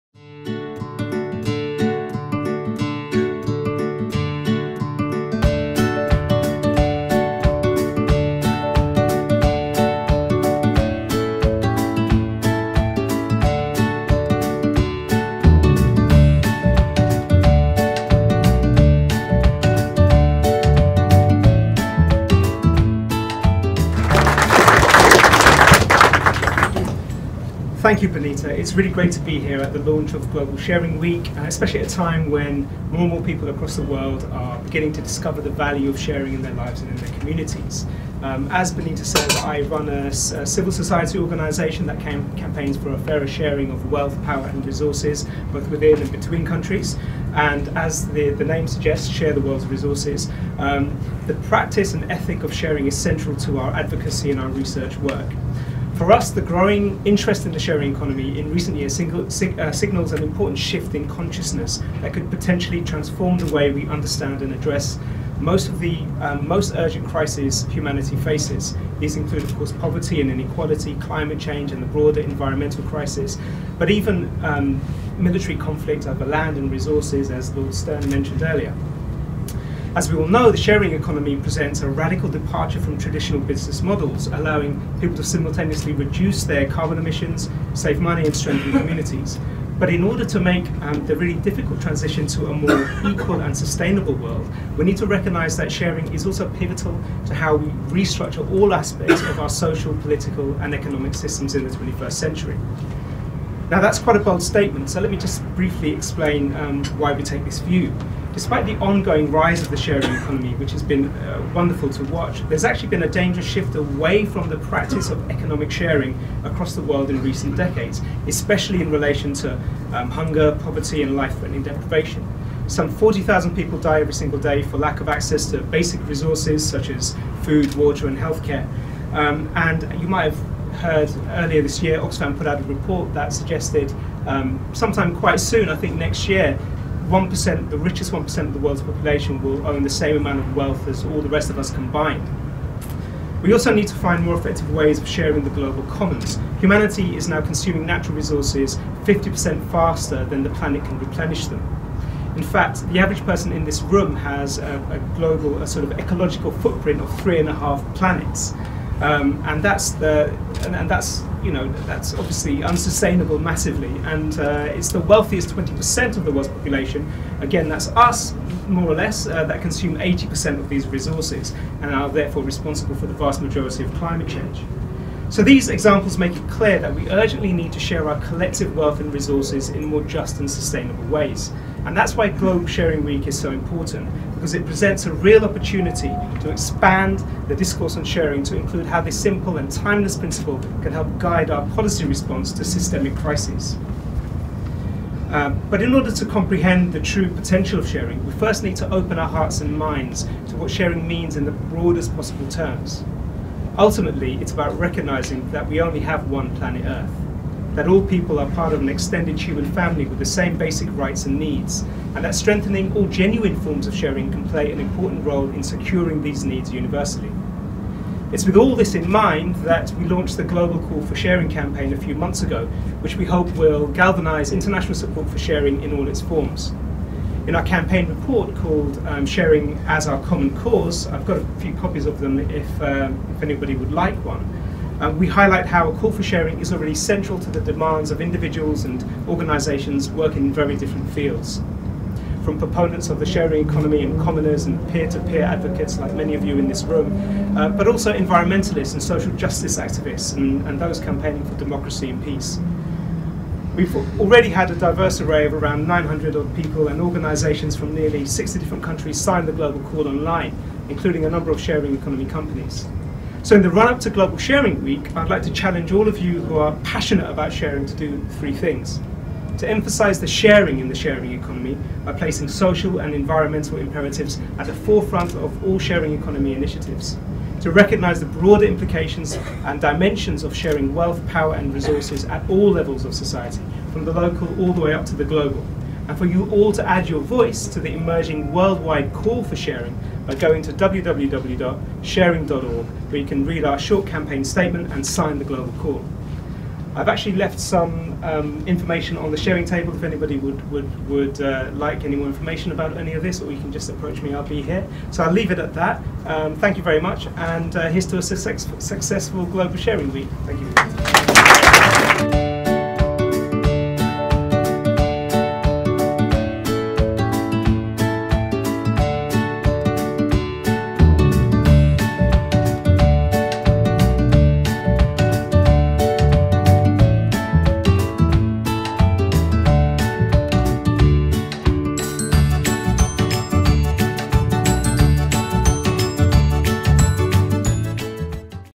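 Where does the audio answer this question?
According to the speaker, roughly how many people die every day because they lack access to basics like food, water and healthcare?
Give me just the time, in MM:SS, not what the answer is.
02:02.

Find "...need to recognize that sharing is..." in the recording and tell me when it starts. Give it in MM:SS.
01:34.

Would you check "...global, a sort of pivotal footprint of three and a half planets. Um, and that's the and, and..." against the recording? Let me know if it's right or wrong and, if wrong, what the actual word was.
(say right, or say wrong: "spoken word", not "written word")
wrong: "ecological", not "pivotal".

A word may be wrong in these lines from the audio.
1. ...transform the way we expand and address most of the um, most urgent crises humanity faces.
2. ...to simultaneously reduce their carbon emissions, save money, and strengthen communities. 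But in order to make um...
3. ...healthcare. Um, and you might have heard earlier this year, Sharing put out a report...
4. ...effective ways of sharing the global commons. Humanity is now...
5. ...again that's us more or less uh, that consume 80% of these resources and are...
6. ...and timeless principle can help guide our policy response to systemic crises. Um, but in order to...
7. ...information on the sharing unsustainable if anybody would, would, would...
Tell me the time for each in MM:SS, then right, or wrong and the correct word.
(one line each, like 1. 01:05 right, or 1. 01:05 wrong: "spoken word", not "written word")
1. 01:02 wrong: "understand", not "expand"
2. 01:25 right
3. 02:08 wrong: "Oxfam", not "Sharing"
4. 02:24 right
5. 02:47 right
6. 03:09 right
7. 04:58 wrong: "table", not "unsustainable".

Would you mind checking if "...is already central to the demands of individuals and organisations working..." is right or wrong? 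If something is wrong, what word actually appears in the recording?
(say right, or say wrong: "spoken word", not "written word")
right.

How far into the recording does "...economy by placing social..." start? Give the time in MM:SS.
04:31.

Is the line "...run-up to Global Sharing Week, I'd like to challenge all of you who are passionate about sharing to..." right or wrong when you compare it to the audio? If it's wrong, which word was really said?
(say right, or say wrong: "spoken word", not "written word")
right.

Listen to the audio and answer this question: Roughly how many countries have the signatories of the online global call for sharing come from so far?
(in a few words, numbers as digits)
nearly 60.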